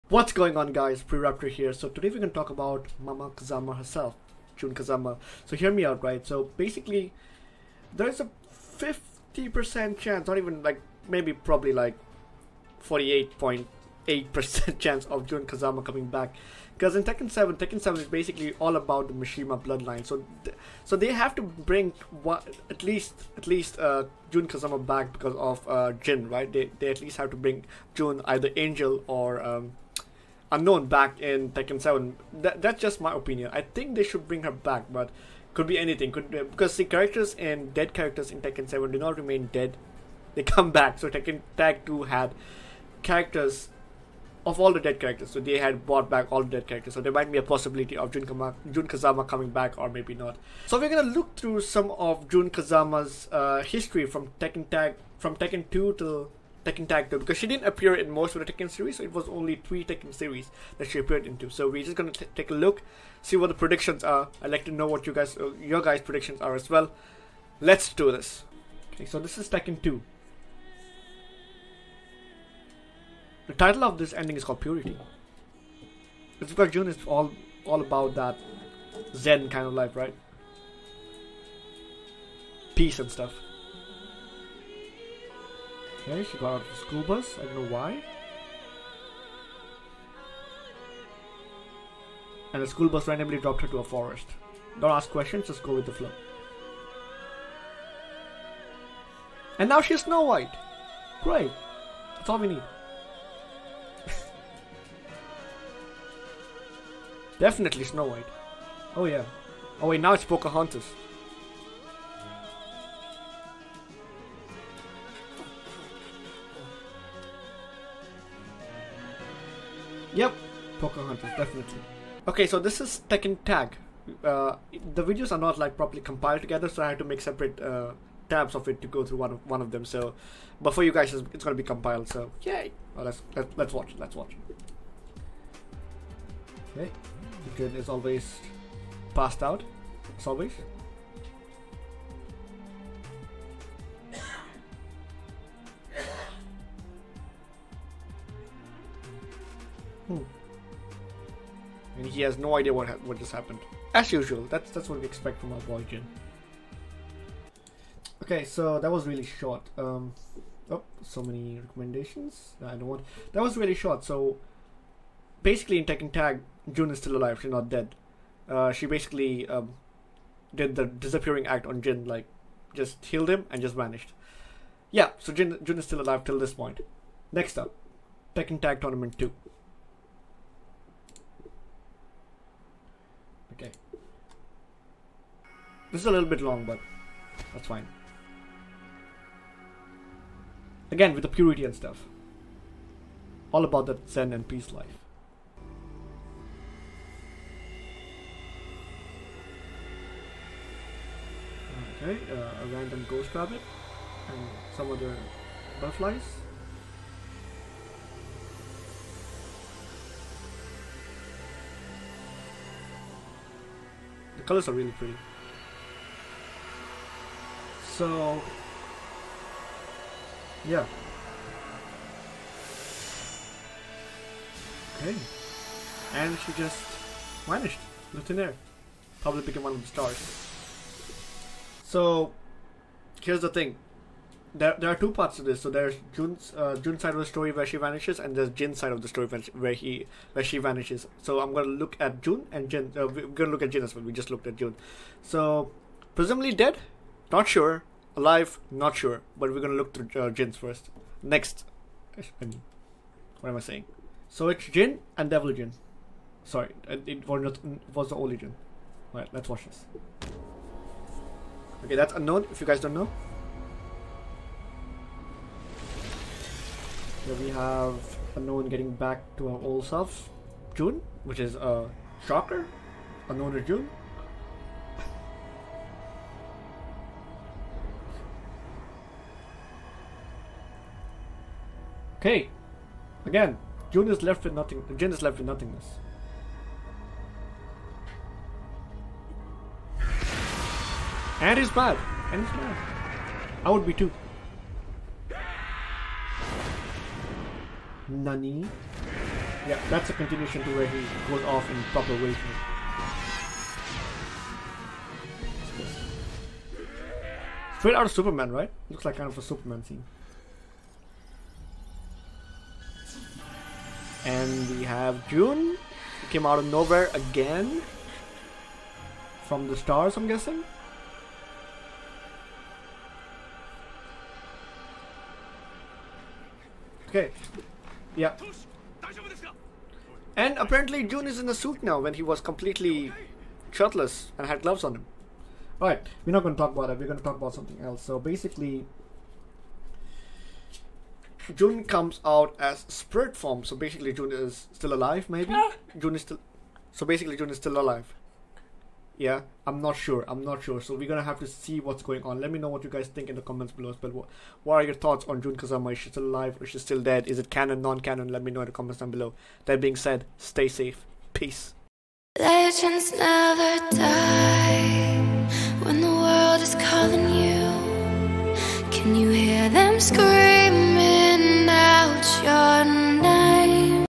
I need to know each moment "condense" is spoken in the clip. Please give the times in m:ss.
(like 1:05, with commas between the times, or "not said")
not said.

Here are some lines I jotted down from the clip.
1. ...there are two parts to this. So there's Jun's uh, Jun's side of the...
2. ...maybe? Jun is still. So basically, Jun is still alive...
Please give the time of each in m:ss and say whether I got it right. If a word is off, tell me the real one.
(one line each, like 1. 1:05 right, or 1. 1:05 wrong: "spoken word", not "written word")
1. 3:54 right
2. 5:45 right.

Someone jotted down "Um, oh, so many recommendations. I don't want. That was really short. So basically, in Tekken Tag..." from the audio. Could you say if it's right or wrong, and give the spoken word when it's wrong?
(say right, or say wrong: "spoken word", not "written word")
right.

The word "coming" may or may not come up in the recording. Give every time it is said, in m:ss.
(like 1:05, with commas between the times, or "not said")
0:15, 0:49.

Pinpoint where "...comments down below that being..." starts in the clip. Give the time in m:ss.
5:58.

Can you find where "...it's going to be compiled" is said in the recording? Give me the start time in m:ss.
2:11.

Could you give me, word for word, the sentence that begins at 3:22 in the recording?
Okay, uh, a random ghost rabbit and some other butterflies.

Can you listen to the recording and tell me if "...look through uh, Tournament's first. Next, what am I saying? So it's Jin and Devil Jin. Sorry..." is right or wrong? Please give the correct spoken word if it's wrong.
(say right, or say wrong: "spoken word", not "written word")
wrong: "Jin", not "Tournament".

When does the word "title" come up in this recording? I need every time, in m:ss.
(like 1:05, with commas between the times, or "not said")
1:13.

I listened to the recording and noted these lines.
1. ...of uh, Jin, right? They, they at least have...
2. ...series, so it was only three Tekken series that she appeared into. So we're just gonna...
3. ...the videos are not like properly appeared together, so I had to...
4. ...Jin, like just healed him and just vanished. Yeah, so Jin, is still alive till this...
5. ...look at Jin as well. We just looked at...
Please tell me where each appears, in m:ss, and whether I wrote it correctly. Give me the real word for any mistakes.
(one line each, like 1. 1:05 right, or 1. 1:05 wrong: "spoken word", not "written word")
1. 0:25 right
2. 0:58 right
3. 2:04 wrong: "compiled", not "appeared"
4. 2:51 right
5. 4:03 right.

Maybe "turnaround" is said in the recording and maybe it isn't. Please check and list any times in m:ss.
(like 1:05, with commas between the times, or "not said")
not said.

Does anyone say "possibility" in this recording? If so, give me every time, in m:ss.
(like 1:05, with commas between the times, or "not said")
0:47.